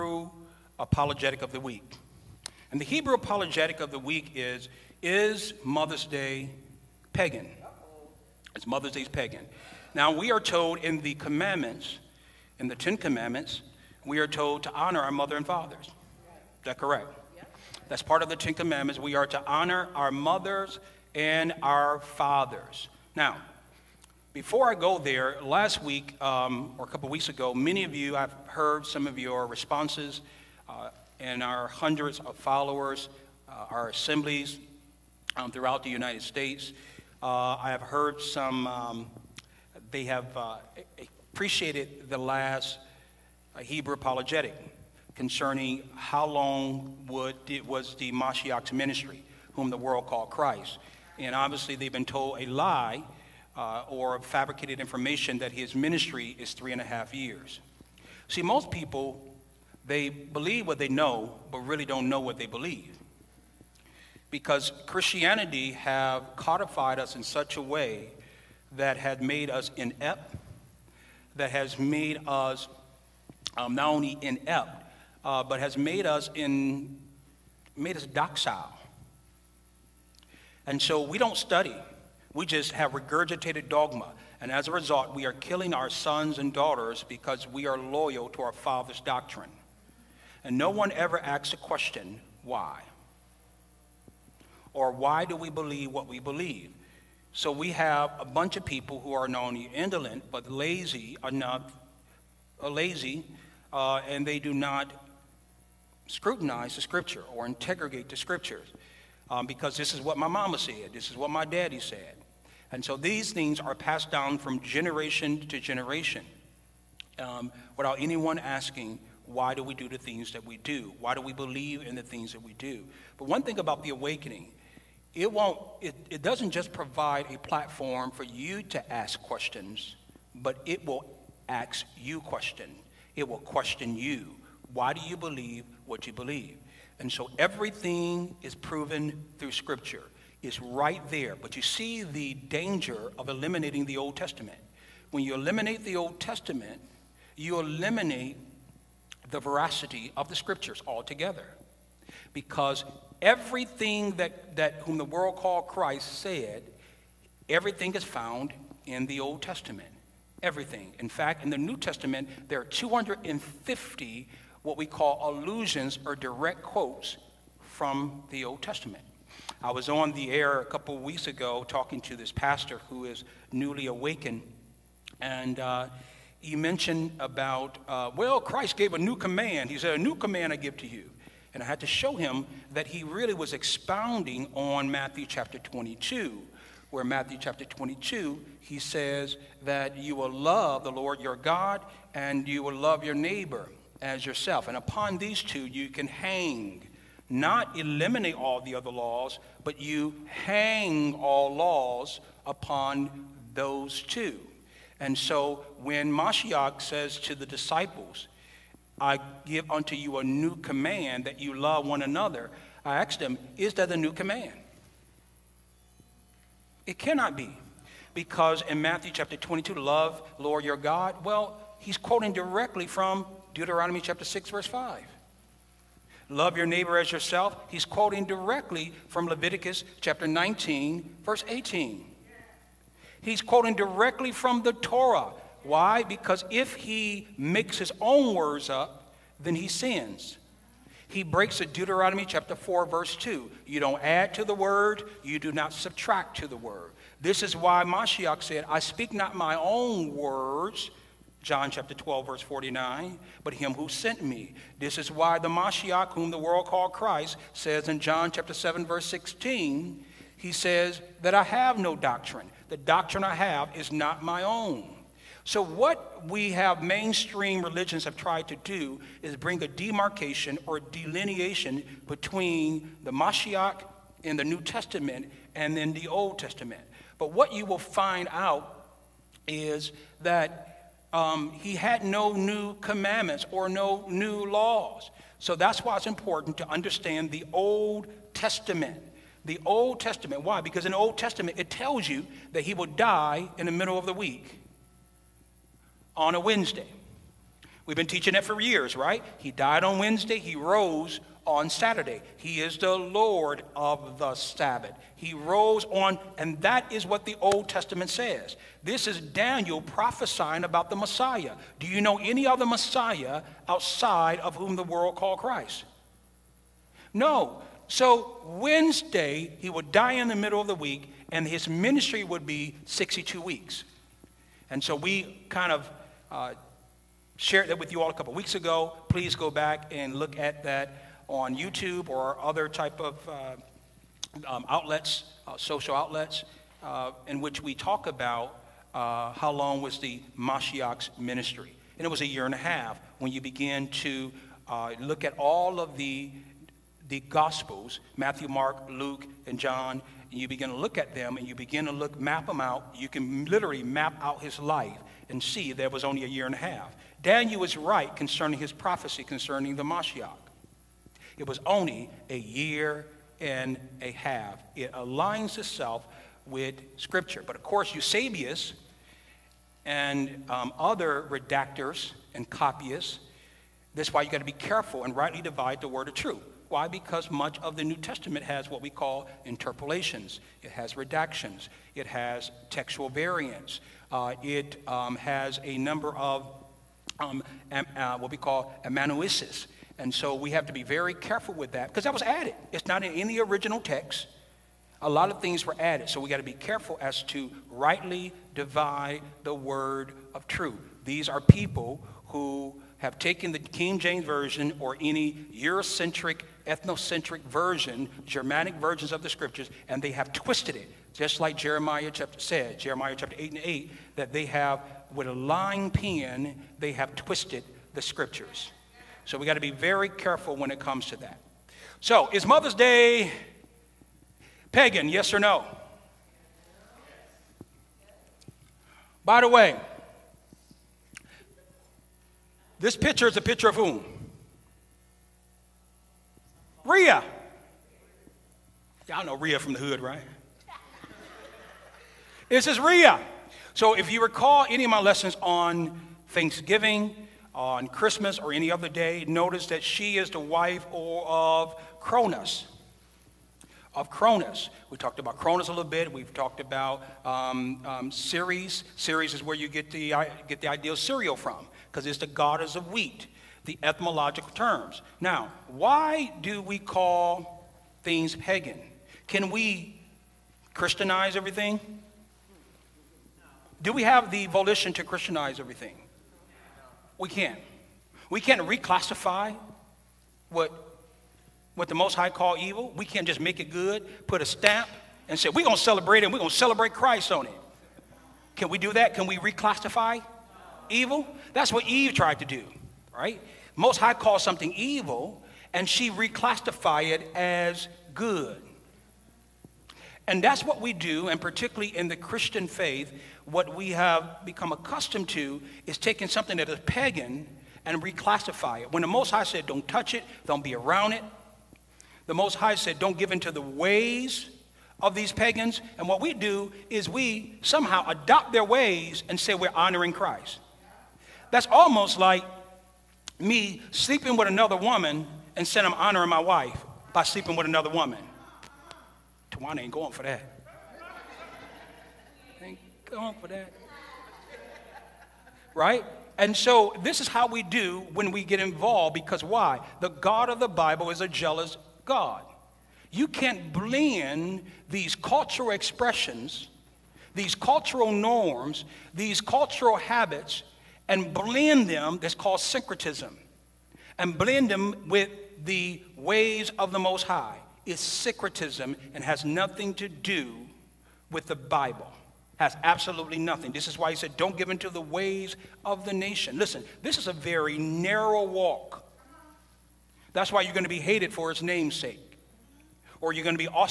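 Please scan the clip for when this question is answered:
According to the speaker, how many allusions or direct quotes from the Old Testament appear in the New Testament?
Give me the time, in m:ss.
2:42.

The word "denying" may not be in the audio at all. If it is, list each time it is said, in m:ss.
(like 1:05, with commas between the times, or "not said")
not said.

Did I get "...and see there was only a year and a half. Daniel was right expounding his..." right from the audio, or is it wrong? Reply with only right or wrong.
wrong.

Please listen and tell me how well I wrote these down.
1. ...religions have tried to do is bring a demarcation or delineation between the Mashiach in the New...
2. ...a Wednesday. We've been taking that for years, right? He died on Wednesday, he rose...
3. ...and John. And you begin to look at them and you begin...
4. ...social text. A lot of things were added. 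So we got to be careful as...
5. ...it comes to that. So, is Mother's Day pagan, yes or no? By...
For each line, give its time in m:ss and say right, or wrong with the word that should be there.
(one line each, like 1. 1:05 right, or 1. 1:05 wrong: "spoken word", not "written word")
1. 4:27 right
2. 4:56 wrong: "teaching", not "taking"
3. 5:49 right
4. 6:33 wrong: "original", not "social"
5. 7:00 right.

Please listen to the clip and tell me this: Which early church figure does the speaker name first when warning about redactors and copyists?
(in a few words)
Eusebius.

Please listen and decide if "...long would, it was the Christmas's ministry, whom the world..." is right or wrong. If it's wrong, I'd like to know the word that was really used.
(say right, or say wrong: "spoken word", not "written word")
wrong: "Mashiach", not "Christmas".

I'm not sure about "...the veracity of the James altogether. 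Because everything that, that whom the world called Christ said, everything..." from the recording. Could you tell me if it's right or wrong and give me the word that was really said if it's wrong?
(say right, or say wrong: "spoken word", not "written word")
wrong: "Scriptures", not "James".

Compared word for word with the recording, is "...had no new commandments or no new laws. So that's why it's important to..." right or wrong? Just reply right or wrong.
right.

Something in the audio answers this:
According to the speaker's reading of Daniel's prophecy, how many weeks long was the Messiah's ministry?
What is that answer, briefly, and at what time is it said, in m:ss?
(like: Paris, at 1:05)
62 weeks, at 5:22.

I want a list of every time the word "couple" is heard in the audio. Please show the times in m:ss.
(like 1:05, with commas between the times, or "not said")
0:26, 2:50, 5:28.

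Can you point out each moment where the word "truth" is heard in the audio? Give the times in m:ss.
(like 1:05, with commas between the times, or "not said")
6:16, 6:40.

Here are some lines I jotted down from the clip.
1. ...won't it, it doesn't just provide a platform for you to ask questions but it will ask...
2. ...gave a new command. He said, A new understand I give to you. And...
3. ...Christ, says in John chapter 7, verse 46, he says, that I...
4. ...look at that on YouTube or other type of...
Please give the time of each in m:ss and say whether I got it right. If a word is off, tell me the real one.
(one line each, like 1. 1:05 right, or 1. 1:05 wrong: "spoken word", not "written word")
1. 2:05 right
2. 2:58 wrong: "command", not "understand"
3. 4:16 wrong: "16", not "46"
4. 5:30 right.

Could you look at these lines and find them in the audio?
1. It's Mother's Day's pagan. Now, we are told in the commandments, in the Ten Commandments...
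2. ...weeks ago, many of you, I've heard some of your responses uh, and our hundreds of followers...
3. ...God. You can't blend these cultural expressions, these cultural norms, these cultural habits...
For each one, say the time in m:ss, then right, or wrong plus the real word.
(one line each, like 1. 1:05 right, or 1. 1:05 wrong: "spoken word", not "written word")
1. 0:08 right
2. 0:27 right
3. 9:02 right.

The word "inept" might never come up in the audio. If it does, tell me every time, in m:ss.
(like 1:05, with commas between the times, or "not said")
1:09, 1:14.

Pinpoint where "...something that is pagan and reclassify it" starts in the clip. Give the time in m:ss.
8:26.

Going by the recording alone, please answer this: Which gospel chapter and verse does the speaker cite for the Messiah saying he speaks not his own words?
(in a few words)
John 12:49.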